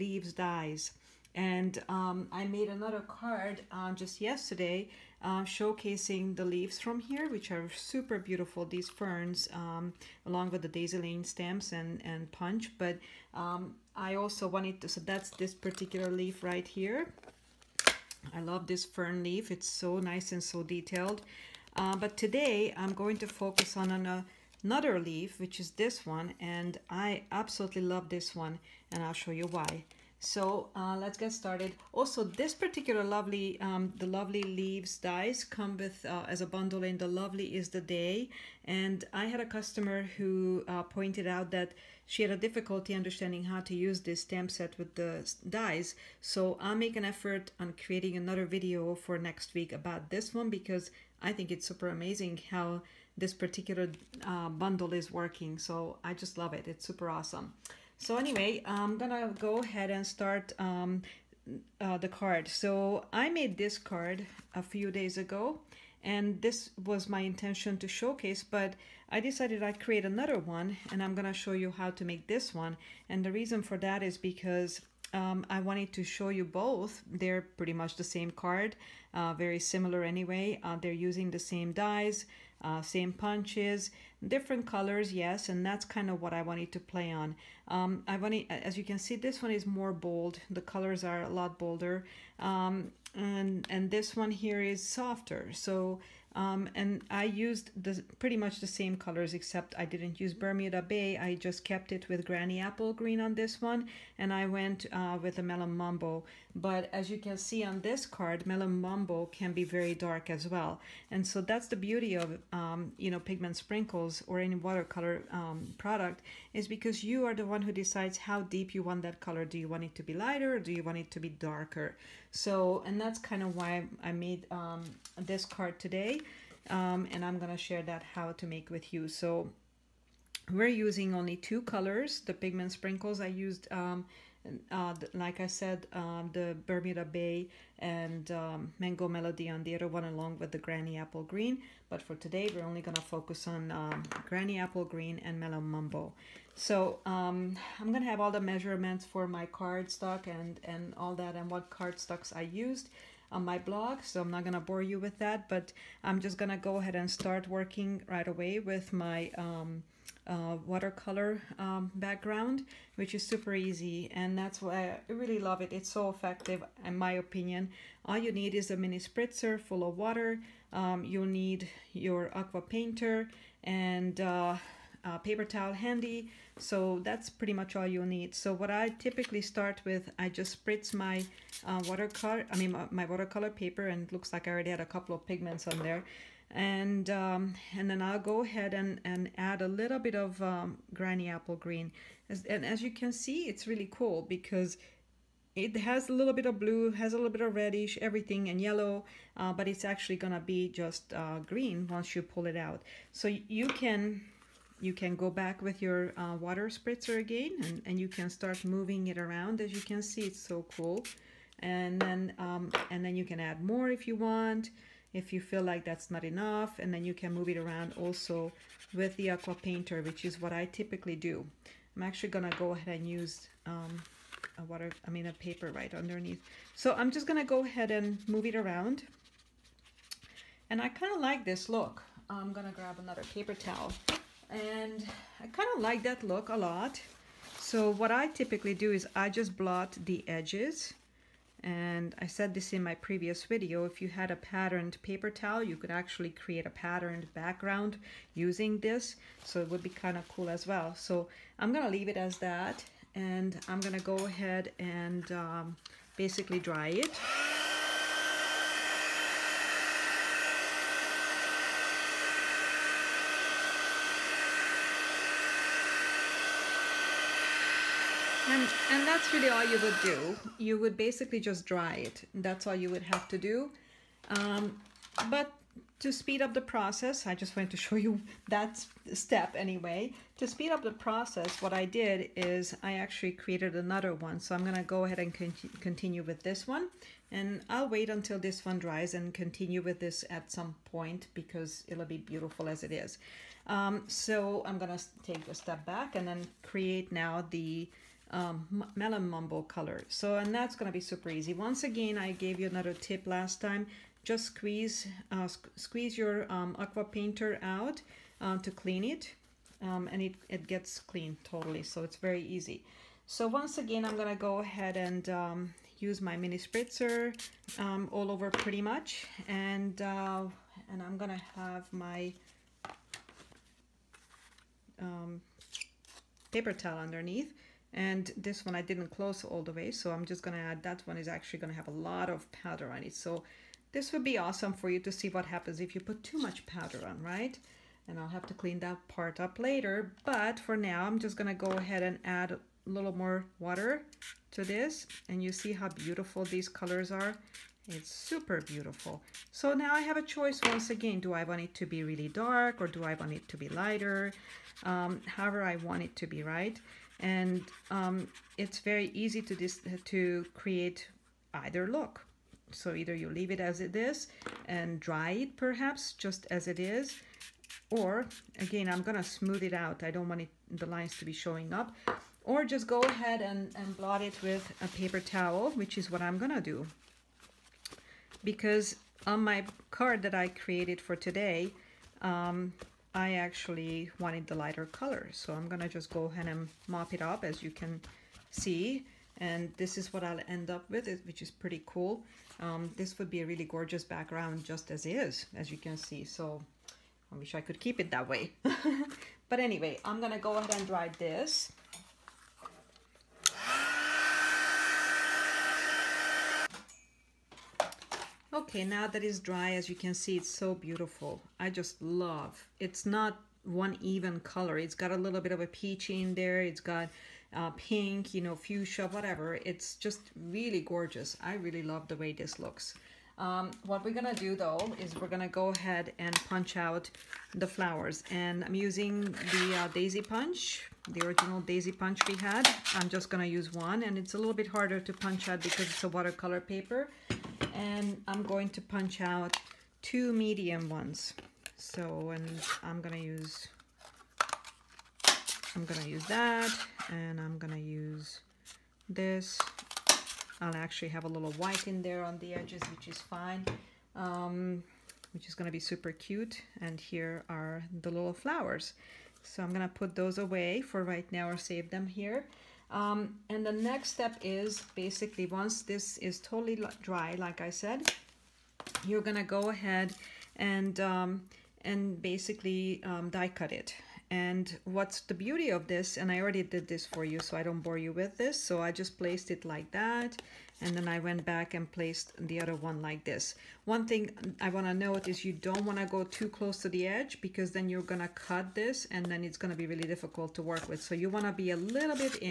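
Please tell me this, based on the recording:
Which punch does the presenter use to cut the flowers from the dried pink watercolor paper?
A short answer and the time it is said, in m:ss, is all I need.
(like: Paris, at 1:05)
Original daisy punch, at 7:11.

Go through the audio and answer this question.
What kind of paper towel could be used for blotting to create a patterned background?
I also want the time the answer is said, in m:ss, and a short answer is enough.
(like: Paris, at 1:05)
A patterned paper towel, at 4:04.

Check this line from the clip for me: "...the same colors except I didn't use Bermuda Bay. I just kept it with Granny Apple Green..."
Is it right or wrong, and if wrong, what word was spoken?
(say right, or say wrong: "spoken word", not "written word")
right.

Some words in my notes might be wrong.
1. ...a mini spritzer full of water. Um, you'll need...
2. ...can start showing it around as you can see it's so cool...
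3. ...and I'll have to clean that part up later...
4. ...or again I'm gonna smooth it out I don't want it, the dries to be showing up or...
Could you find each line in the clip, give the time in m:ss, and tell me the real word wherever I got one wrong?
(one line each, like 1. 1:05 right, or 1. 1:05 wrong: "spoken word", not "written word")
1. 2:48 right
2. 3:28 wrong: "moving", not "showing"
3. 5:38 right
4. 6:07 wrong: "lines", not "dries".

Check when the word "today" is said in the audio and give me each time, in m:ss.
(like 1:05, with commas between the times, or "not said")
0:22, 2:05, 2:22, 6:21.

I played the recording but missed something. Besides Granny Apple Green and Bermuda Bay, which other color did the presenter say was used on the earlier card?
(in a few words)
Mango Melody.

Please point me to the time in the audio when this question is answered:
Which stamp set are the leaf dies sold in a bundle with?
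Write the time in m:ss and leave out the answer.
0:36.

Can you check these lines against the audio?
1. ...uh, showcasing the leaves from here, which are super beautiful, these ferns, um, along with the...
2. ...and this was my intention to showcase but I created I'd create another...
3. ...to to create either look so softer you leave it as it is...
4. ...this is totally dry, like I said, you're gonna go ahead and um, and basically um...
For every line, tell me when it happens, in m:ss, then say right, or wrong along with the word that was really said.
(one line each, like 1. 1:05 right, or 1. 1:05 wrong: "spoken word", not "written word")
1. 0:05 right
2. 1:06 wrong: "decided", not "created"
3. 5:59 wrong: "either", not "softer"
4. 7:45 right.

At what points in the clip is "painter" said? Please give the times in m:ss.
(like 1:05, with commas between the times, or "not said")
2:52, 3:39, 5:07.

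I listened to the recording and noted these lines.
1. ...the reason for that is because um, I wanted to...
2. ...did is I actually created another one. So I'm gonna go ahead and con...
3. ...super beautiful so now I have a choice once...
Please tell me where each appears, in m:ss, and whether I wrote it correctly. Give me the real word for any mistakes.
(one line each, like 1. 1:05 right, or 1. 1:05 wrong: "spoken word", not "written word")
1. 1:13 right
2. 4:41 right
3. 5:48 right.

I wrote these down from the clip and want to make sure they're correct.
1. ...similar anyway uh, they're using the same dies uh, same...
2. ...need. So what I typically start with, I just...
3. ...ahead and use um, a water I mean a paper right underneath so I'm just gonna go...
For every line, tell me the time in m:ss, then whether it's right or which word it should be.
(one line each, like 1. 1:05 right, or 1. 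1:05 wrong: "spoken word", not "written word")
1. 1:19 right
2. 2:58 right
3. 3:42 right.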